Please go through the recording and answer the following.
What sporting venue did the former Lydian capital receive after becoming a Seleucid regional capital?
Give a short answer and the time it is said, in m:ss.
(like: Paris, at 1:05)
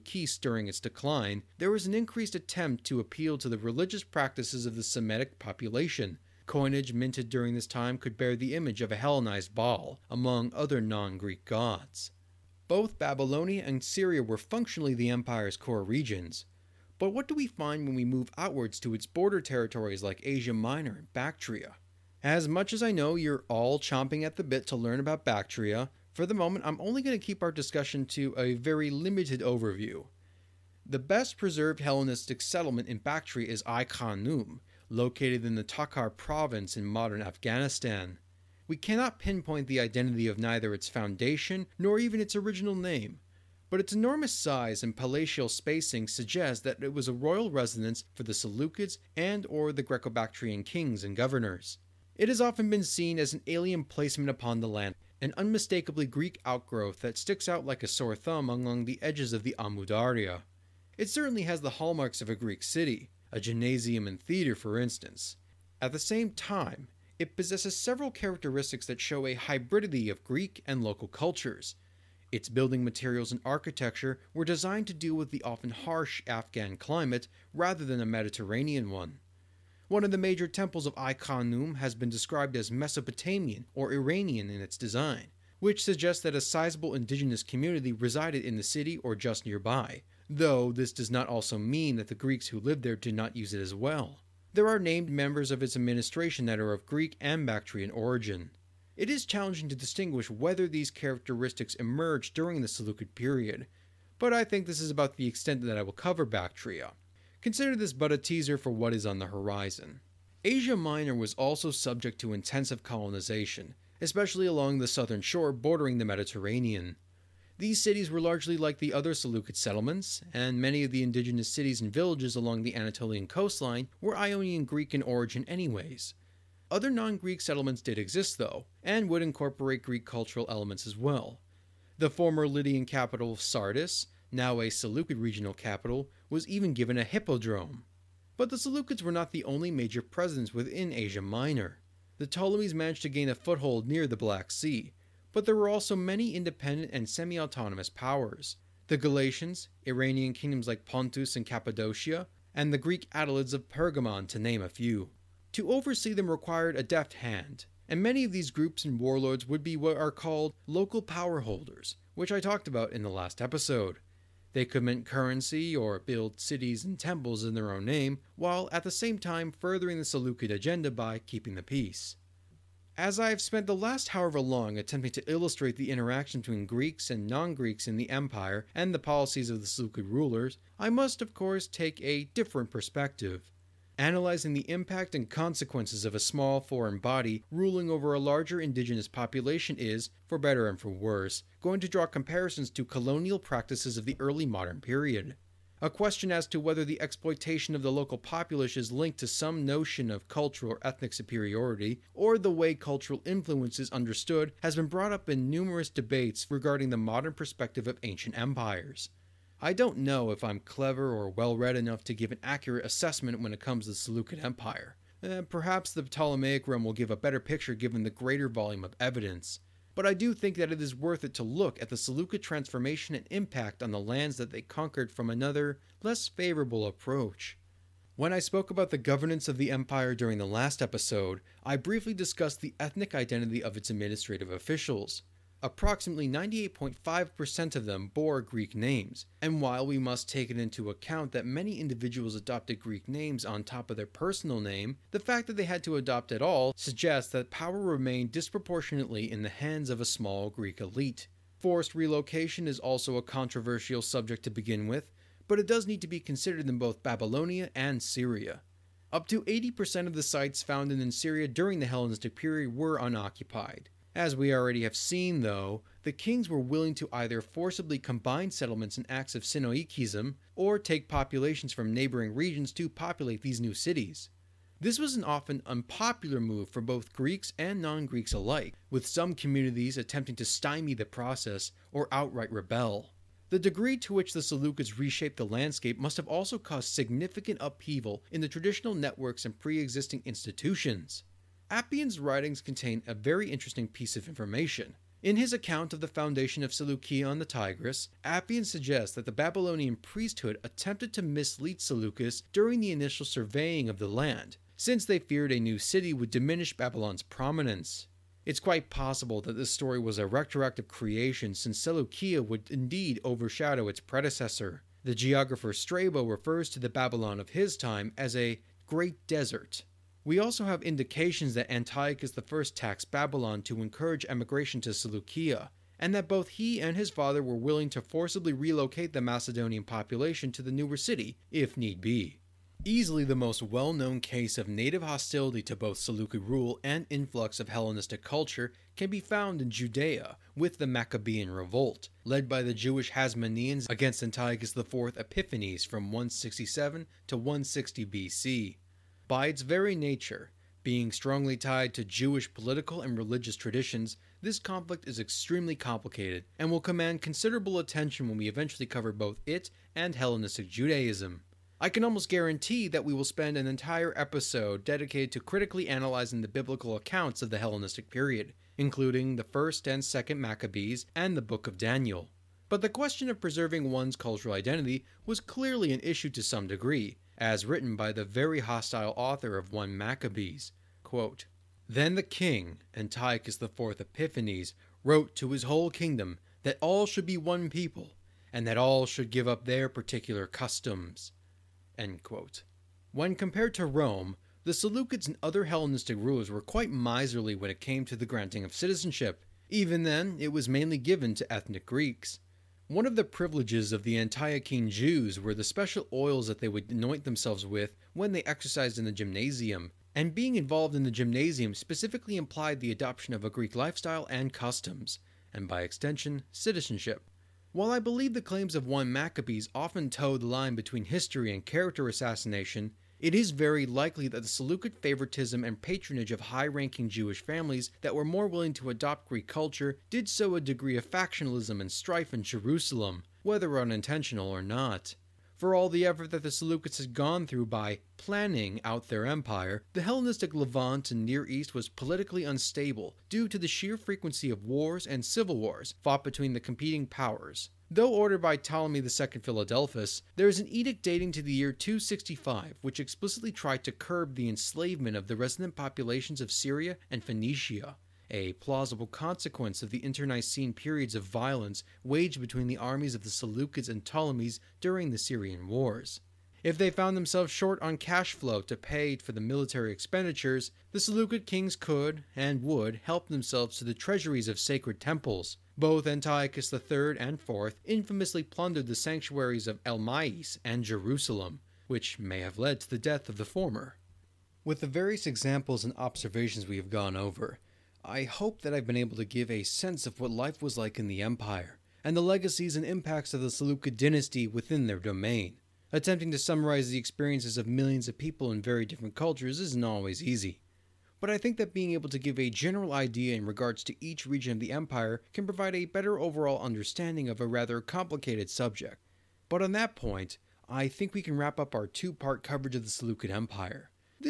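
A hippodrome, at 2:17.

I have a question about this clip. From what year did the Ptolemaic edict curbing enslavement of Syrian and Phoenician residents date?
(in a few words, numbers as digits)
265.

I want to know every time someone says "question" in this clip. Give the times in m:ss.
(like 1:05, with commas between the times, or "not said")
3:15, 6:12.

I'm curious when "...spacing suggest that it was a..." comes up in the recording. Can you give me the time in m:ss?
0:45.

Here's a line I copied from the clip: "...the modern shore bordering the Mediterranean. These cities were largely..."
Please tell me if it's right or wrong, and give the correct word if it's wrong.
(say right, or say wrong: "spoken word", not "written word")
wrong: "southern", not "modern".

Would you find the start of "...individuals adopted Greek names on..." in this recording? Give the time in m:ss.
4:01.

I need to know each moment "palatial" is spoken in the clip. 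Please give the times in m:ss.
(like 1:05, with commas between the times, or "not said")
0:44.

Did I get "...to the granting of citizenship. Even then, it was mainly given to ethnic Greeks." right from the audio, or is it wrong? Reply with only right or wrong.
right.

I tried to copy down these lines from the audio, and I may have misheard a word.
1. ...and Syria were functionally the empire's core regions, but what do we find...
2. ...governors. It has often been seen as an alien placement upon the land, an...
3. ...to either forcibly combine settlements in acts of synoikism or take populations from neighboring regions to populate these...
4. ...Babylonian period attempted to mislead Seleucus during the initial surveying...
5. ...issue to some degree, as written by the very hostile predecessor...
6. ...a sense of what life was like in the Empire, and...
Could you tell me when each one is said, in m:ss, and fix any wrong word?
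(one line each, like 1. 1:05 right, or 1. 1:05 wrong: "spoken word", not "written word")
1. 0:13 right
2. 0:51 right
3. 4:26 right
4. 4:59 wrong: "priesthood", not "period"
5. 6:16 wrong: "author", not "predecessor"
6. 8:09 right.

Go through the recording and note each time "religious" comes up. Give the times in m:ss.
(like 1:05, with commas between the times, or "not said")
0:03, 5:53.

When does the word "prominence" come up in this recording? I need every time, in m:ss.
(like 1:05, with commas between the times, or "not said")
5:07.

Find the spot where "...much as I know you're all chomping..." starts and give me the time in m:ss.
0:22.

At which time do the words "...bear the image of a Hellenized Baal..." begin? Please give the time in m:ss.
0:08.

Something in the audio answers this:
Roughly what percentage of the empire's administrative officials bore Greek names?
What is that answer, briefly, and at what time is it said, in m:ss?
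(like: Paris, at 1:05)
98.5%, at 3:56.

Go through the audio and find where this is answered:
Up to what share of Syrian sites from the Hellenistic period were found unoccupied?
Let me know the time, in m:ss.
4:19.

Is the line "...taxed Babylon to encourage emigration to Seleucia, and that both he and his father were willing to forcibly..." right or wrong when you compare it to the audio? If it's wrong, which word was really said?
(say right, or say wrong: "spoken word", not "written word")
right.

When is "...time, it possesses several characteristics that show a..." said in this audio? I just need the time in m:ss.
1:06.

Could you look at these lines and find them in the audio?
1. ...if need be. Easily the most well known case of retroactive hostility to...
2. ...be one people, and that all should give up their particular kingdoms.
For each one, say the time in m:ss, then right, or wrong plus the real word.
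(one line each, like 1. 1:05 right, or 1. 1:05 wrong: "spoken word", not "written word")
1. 5:31 wrong: "native", not "retroactive"
2. 6:27 wrong: "customs", not "kingdoms".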